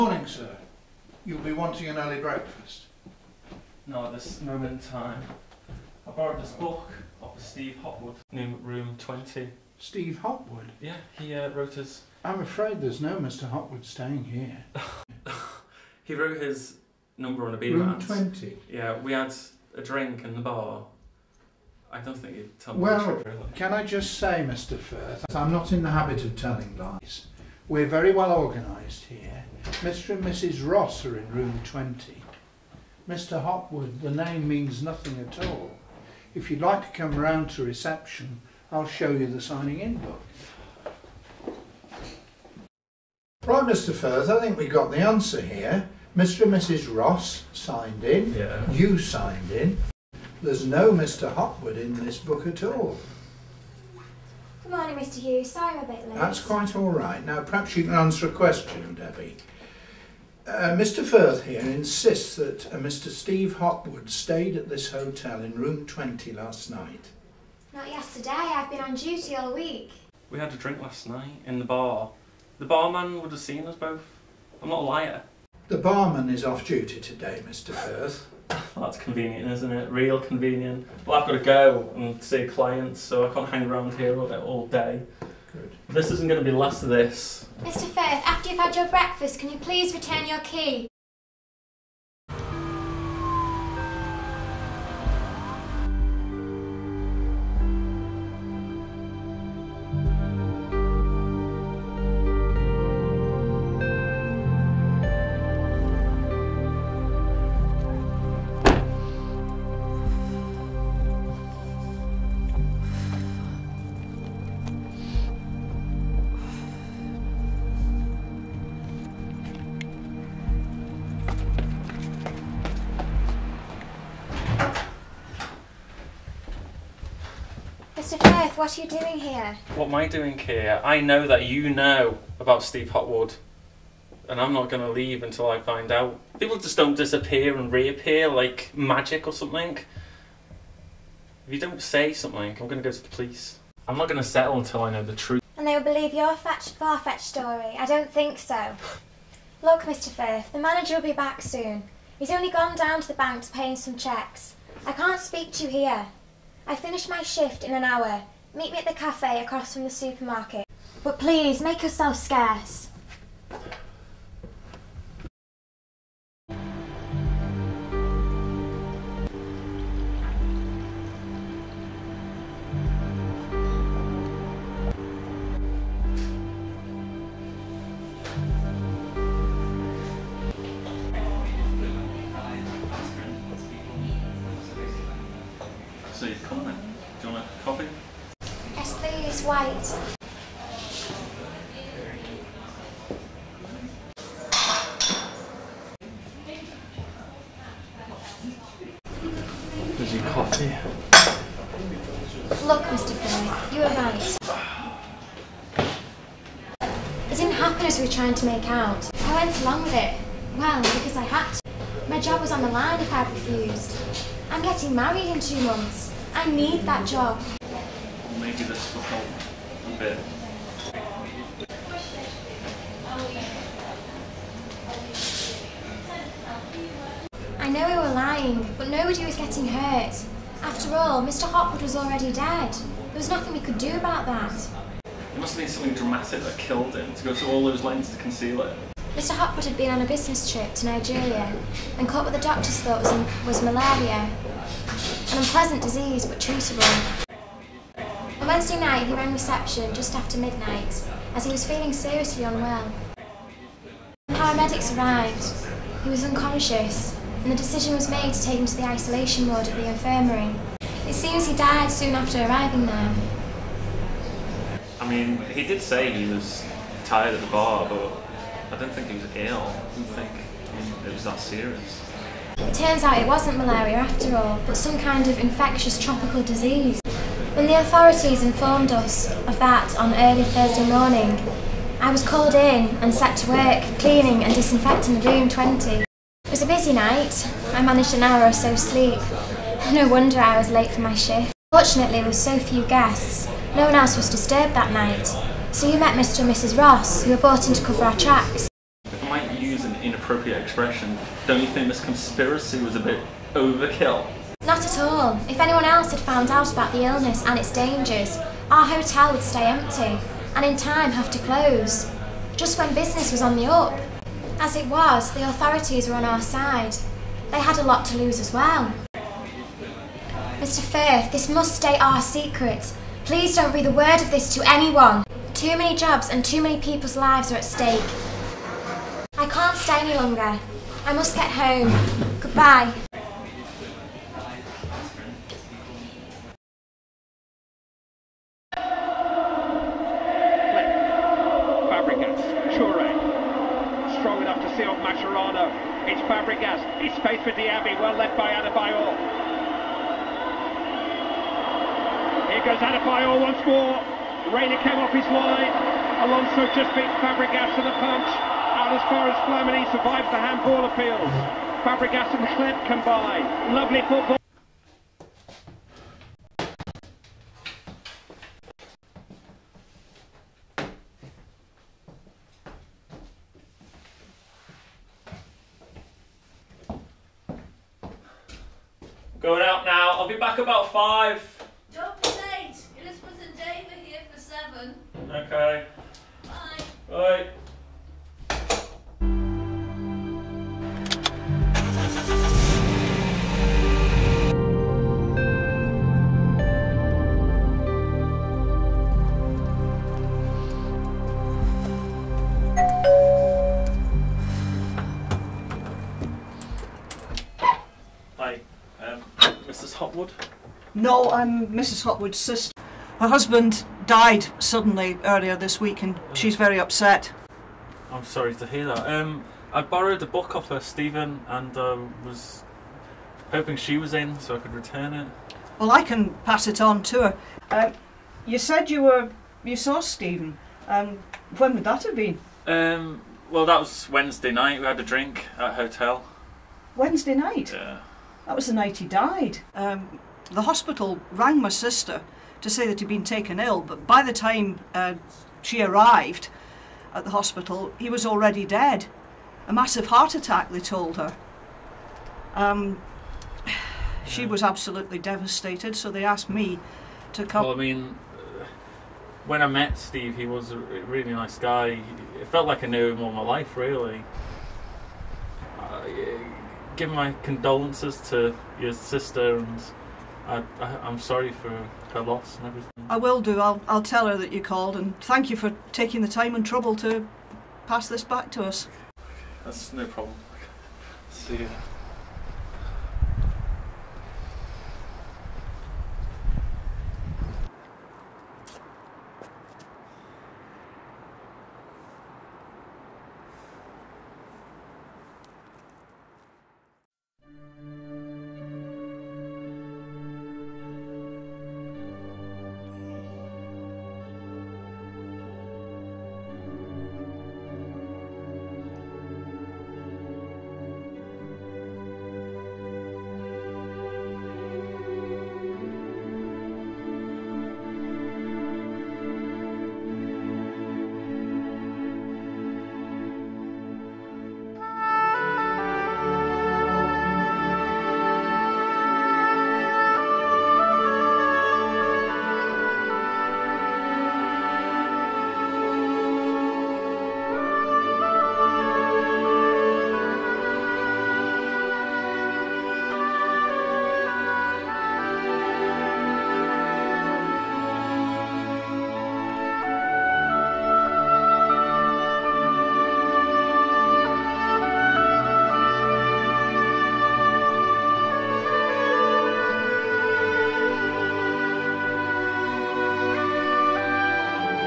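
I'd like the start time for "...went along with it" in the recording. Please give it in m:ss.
3:29.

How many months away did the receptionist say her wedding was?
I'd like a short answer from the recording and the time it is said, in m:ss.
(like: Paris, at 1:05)
2, at 3:35.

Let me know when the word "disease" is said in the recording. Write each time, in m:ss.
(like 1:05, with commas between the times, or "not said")
4:05, 4:36.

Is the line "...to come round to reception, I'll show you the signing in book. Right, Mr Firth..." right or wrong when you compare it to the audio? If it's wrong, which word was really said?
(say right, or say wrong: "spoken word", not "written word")
right.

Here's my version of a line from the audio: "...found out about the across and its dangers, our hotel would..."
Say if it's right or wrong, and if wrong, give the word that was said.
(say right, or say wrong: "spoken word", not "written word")
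wrong: "illness", not "across".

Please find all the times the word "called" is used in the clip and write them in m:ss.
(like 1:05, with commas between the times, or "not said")
4:42, 7:54.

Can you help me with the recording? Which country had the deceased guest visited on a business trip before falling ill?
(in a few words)
Nigeria.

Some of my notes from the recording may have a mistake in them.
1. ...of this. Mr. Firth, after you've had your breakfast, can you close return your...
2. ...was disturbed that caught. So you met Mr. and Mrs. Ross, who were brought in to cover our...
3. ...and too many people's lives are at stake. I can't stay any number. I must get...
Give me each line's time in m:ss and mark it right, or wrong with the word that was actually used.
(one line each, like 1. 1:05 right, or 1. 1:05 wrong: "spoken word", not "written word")
1. 1:26 wrong: "please", not "close"
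2. 4:54 wrong: "night", not "caught"
3. 5:26 wrong: "longer", not "number".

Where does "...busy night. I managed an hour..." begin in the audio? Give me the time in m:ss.
4:46.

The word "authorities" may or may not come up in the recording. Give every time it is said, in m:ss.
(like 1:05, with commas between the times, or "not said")
4:37, 5:15.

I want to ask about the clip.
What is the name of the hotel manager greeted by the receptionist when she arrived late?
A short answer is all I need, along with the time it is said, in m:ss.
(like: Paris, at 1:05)
Mr Hughes, at 0:54.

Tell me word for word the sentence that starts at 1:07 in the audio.
Not yesterday, I've been on duty all week.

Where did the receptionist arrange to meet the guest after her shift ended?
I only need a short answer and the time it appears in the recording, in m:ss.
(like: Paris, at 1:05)
the cafe across from the supermarket, at 2:38.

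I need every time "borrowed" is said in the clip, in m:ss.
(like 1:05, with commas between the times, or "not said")
0:06, 6:59.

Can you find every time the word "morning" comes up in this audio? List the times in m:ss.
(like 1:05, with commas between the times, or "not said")
0:54, 4:40.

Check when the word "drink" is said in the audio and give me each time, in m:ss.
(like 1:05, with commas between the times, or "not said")
0:19, 1:10, 7:15.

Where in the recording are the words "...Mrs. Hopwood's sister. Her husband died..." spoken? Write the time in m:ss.
6:51.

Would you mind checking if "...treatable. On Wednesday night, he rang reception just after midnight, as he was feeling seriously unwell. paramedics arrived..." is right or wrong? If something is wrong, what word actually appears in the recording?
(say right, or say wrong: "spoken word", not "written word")
right.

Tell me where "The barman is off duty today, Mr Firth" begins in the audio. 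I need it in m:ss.
1:15.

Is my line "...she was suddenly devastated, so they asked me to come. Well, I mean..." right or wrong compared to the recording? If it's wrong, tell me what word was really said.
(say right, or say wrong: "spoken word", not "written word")
wrong: "absolutely", not "suddenly".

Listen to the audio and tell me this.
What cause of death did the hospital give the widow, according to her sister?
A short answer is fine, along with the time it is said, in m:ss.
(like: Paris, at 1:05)
a massive heart attack, at 7:29.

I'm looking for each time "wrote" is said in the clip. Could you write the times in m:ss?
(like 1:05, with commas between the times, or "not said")
0:11, 0:16.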